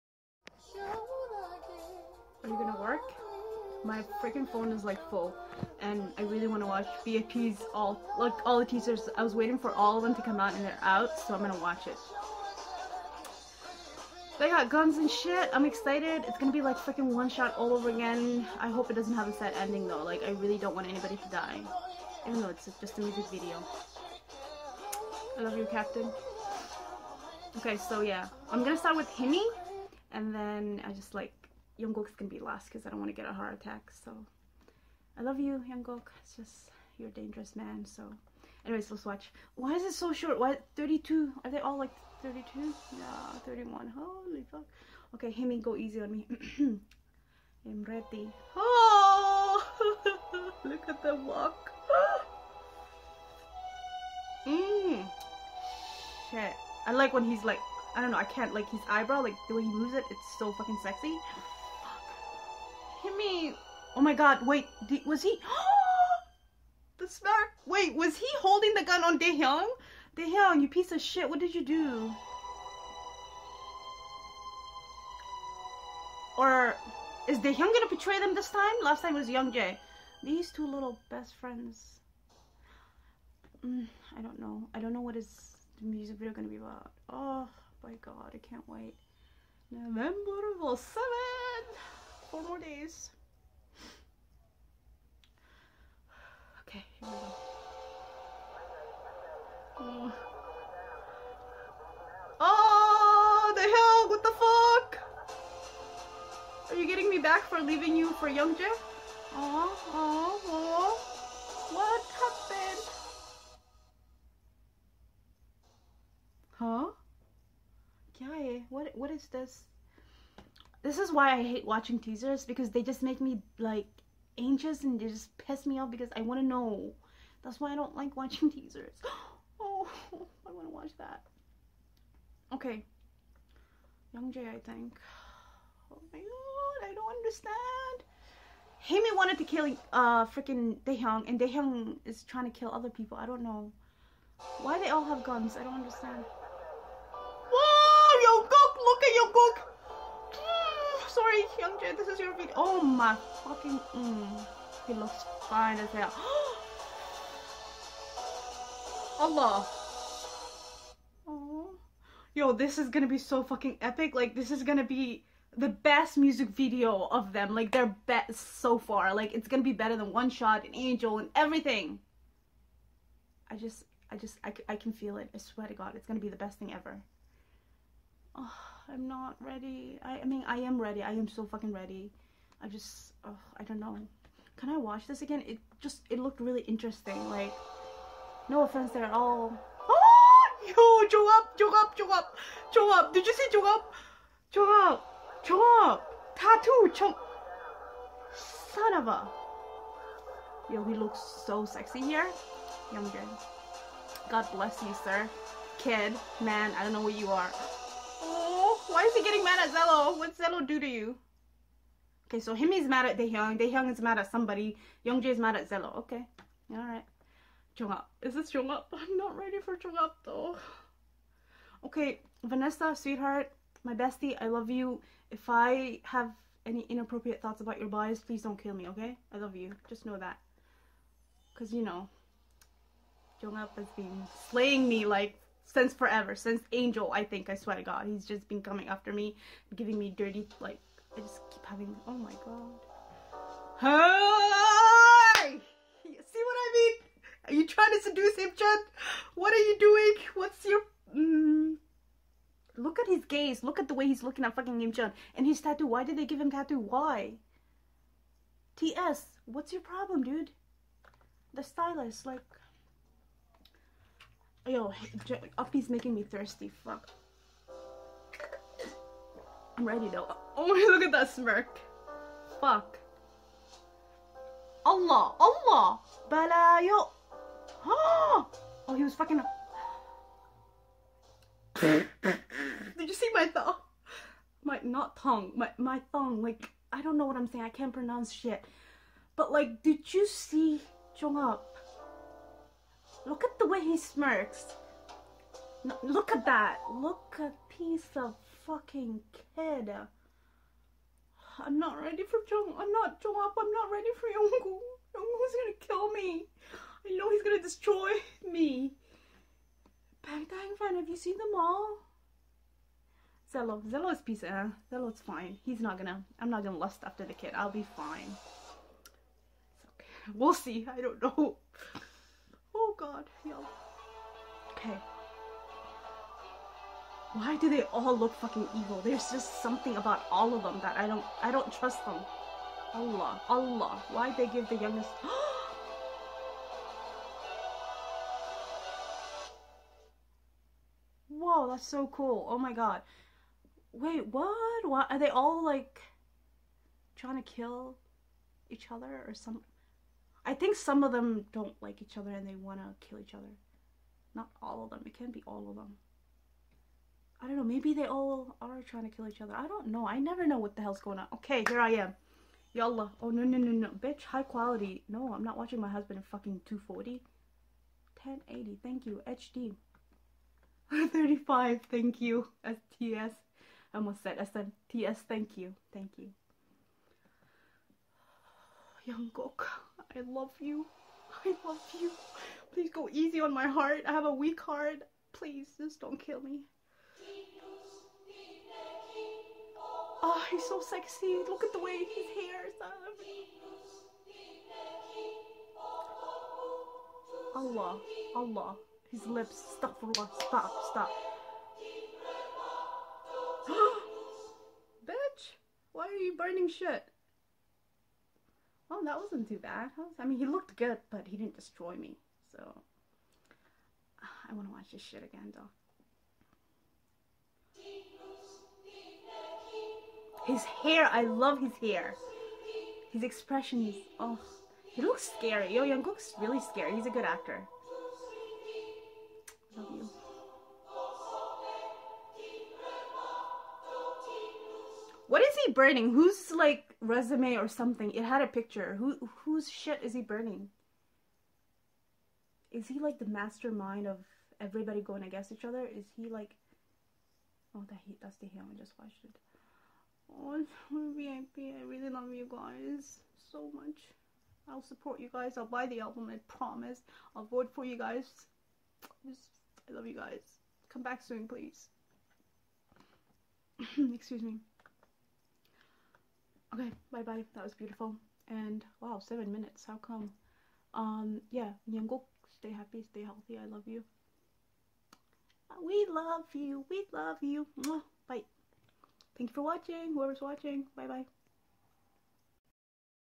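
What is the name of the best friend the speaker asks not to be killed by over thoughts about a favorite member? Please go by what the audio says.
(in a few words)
Vanessa.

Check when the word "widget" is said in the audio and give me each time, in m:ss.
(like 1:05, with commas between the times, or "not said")
not said.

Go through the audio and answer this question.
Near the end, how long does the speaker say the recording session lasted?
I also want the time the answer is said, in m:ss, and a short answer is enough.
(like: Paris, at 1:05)
7 minutes, at 7:49.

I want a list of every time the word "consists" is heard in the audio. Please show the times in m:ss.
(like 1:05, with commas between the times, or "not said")
not said.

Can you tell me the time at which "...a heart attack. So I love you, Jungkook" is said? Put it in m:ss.
0:33.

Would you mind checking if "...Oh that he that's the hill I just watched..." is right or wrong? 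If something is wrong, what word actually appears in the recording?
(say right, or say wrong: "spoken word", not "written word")
right.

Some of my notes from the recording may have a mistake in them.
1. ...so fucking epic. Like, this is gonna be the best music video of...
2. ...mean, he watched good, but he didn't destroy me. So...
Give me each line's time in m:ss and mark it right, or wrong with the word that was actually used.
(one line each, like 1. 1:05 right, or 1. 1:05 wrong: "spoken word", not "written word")
1. 2:43 right
2. 6:50 wrong: "looked", not "watched".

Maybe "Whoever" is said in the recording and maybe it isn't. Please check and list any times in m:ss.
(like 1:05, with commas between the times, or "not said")
8:00.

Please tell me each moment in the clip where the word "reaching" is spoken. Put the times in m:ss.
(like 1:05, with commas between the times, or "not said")
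not said.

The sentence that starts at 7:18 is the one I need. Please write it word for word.
Who whose shit is he burning?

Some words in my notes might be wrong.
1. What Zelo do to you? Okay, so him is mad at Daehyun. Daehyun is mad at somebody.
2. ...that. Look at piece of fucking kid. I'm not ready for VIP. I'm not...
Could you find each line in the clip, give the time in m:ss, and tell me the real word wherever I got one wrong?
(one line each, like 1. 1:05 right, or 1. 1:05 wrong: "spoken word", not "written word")
1. 3:30 right
2. 4:56 wrong: "Jung", not "VIP".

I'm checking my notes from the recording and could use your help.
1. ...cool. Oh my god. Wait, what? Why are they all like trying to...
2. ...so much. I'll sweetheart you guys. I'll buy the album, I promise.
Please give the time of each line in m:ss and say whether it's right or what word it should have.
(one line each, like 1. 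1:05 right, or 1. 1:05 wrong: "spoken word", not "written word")
1. 5:42 right
2. 7:33 wrong: "support", not "sweetheart".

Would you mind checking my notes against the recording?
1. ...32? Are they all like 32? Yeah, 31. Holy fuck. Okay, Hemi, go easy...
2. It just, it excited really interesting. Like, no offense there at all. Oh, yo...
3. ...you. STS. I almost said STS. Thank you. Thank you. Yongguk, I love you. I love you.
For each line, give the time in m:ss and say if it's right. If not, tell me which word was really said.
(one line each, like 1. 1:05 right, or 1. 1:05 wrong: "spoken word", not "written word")
1. 0:40 right
2. 3:05 wrong: "looked", not "excited"
3. 6:12 right.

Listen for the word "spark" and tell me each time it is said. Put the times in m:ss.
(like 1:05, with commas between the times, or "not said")
1:07.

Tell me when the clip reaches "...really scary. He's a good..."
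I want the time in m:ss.
7:06.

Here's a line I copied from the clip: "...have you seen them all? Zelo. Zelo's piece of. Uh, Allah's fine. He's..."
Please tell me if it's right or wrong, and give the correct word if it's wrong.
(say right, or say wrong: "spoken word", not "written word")
wrong: "Zelo", not "Allah".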